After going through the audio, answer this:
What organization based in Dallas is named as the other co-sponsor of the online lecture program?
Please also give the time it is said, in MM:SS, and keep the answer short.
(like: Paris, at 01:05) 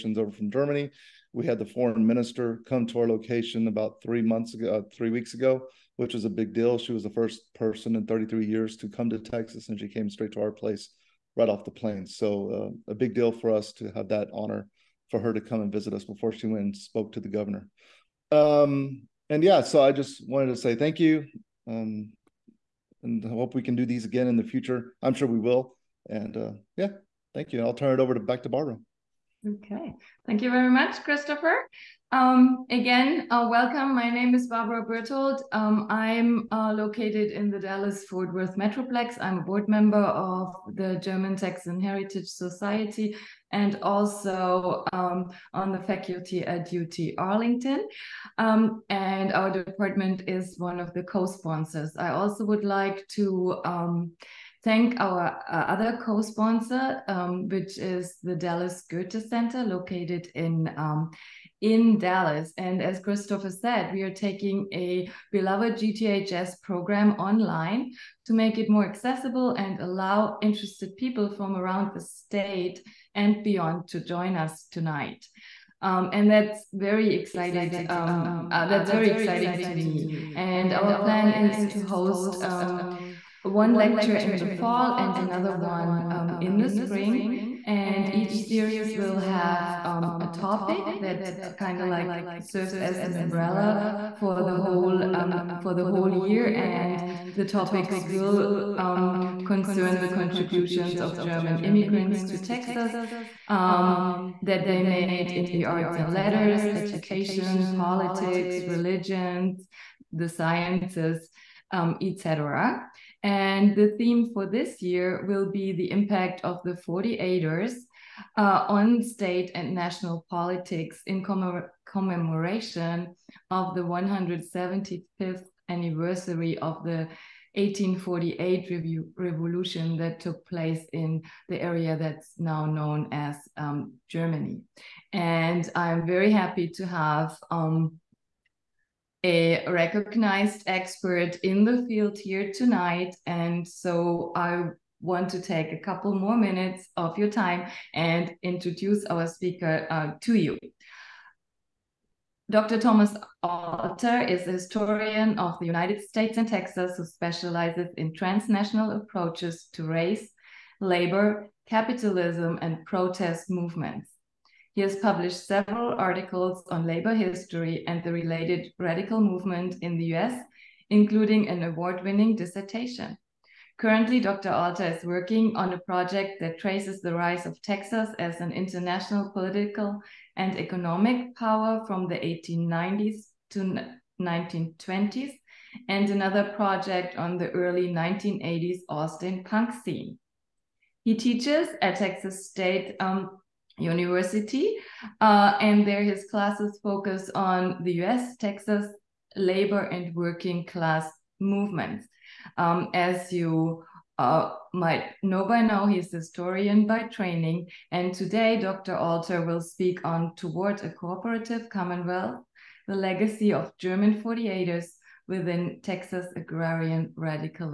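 Dallas Goethe Center, at 00:58.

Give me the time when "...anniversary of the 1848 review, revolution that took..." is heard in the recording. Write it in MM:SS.
02:05.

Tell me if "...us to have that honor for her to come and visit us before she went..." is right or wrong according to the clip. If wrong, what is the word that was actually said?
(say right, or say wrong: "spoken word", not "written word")
right.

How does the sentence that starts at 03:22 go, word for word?
Um, as you uh, might know by now, he's a historian by training, and today Dr.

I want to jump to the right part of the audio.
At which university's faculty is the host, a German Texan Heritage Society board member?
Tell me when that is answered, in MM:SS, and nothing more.
00:46.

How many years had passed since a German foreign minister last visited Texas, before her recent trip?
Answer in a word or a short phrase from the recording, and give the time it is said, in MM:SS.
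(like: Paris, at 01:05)
33, at 00:08.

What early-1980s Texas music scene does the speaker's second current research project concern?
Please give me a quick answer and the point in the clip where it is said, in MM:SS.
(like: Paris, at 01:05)
Austin punk scene, at 03:08.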